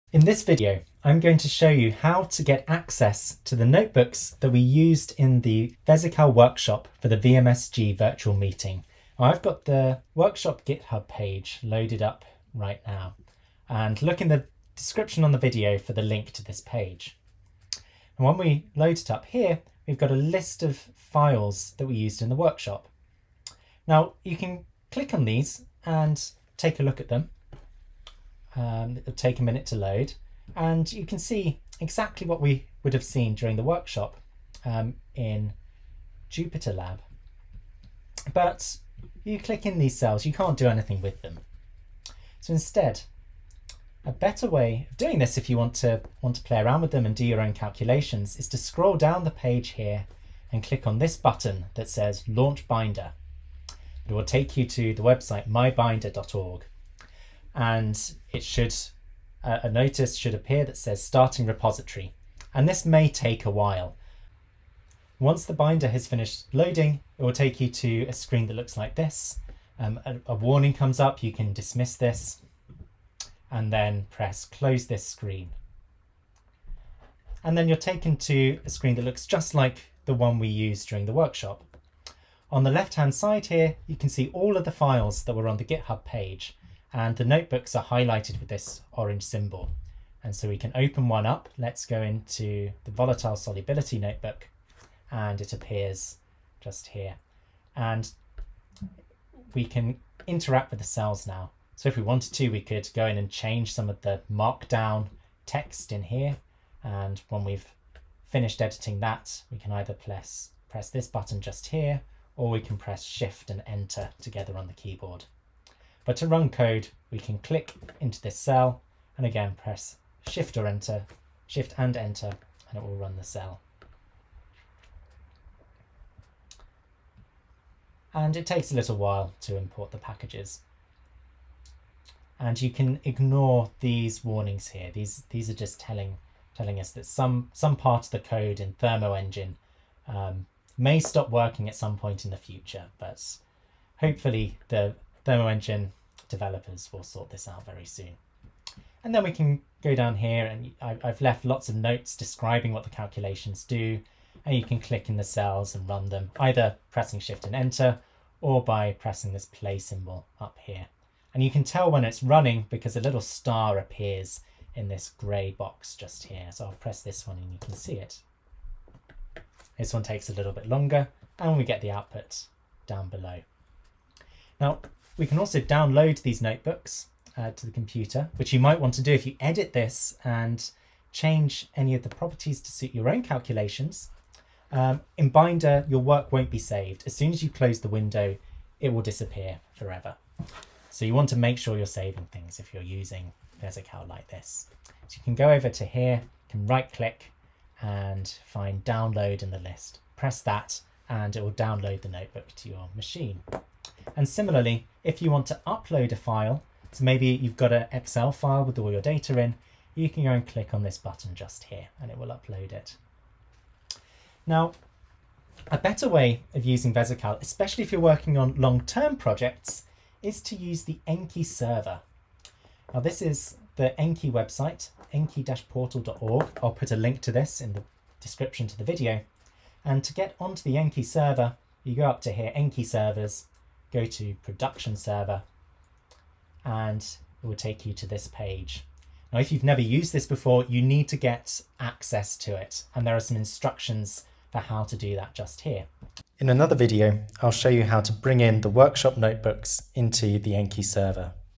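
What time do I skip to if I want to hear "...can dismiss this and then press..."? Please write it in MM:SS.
01:11.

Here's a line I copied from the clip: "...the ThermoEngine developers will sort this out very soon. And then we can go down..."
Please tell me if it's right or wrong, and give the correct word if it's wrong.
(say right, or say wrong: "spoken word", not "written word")
right.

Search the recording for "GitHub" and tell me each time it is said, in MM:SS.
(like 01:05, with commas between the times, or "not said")
00:10, 01:25.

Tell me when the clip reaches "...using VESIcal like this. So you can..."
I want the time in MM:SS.
03:12.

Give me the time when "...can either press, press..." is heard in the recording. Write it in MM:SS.
01:49.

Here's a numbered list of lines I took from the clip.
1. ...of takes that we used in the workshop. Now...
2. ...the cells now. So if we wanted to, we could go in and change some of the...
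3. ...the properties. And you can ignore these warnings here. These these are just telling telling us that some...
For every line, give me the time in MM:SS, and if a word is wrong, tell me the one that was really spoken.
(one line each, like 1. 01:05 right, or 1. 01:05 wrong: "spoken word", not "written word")
1. 00:20 wrong: "files", not "takes"
2. 01:40 right
3. 02:09 wrong: "packages", not "properties".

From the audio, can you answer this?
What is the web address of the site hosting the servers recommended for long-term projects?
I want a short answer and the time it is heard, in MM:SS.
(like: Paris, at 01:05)
enki-portal.org, at 03:45.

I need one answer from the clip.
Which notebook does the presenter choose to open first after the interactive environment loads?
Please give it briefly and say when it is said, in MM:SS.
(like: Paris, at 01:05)
volatile solubility, at 01:32.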